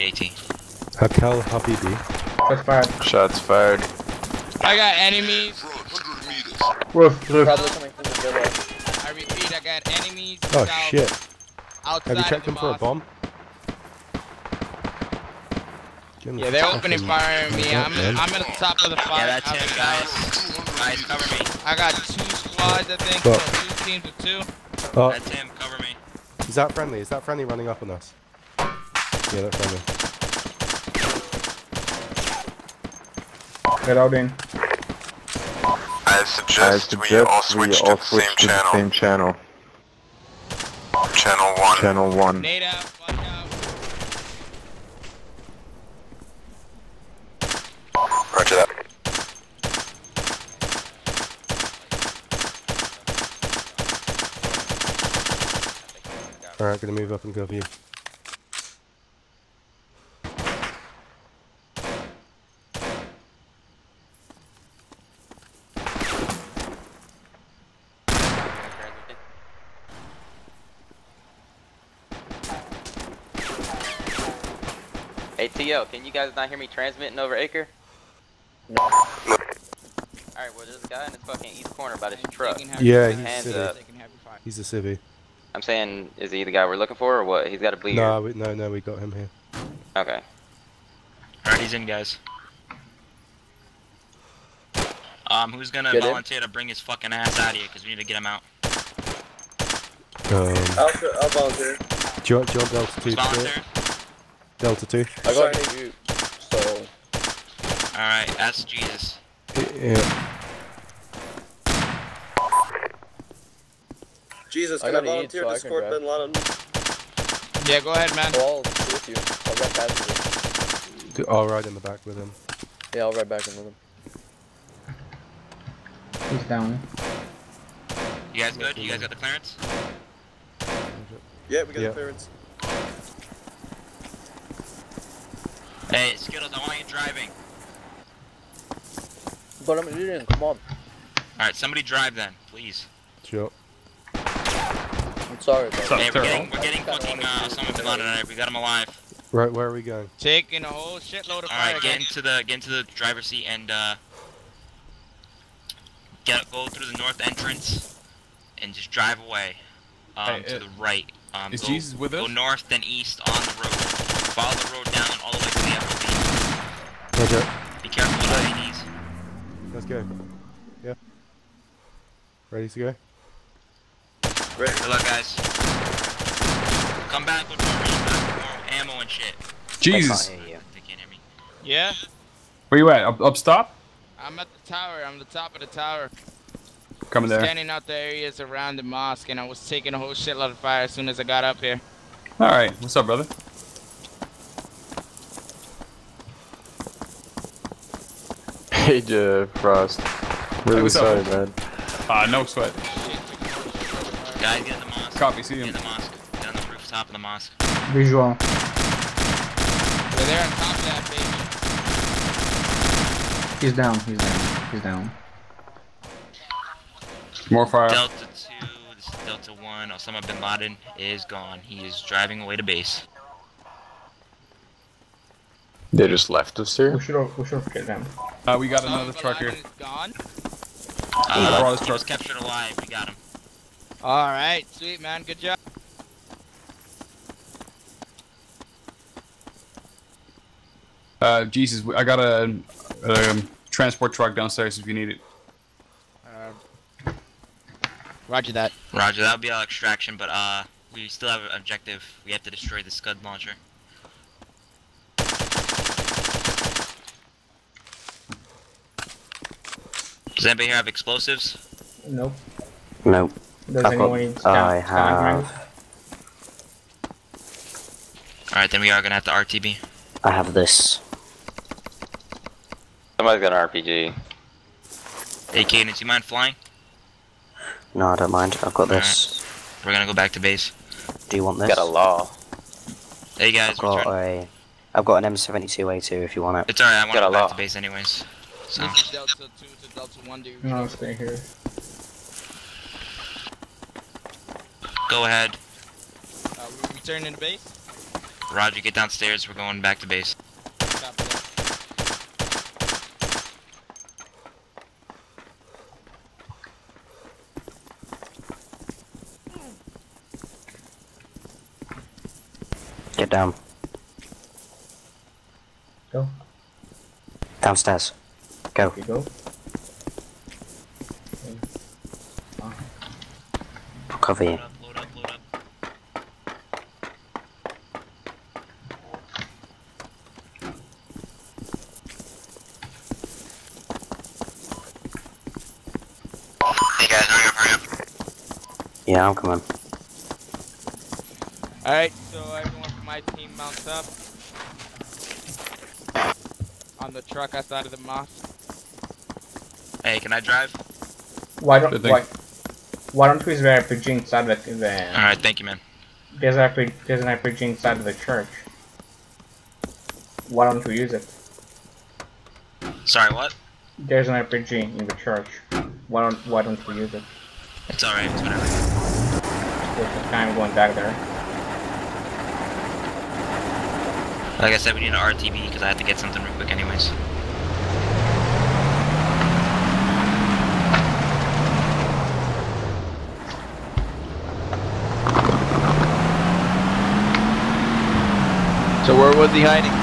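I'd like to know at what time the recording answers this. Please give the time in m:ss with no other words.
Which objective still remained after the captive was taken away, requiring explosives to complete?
4:12.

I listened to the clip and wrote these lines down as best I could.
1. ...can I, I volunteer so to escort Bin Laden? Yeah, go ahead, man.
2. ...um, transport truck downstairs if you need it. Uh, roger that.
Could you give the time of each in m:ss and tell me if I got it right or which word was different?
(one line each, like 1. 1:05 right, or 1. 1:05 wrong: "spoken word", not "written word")
1. 1:54 right
2. 4:03 right.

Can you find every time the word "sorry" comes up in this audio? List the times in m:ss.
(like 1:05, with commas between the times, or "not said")
1:45, 2:25, 3:20, 6:03.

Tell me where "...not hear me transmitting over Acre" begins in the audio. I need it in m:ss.
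1:16.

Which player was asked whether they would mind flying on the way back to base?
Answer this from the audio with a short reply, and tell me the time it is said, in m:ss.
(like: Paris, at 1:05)
Cadence, at 4:35.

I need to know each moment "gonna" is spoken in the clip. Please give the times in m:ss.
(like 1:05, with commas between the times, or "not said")
0:56, 1:35, 4:29, 4:39.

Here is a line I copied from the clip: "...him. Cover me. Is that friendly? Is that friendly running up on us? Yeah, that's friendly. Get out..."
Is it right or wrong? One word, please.
right.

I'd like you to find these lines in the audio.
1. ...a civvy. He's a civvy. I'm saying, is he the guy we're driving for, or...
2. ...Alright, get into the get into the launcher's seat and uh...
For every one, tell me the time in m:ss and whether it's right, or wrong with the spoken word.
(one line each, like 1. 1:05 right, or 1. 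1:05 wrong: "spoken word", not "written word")
1. 1:23 wrong: "looking", not "driving"
2. 2:31 wrong: "driver", not "launcher".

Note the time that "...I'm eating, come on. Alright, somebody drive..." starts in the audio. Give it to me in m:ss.
2:19.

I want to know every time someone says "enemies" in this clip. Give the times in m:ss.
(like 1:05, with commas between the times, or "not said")
0:04, 0:10.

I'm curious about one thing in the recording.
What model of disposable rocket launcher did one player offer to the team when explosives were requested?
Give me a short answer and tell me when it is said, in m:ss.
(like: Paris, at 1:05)
M72A2, at 4:45.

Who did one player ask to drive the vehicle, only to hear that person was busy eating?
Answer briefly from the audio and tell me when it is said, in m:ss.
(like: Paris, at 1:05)
Skittles, at 2:16.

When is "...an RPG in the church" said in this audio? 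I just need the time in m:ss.
6:04.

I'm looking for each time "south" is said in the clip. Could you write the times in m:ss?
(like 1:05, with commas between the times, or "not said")
0:10.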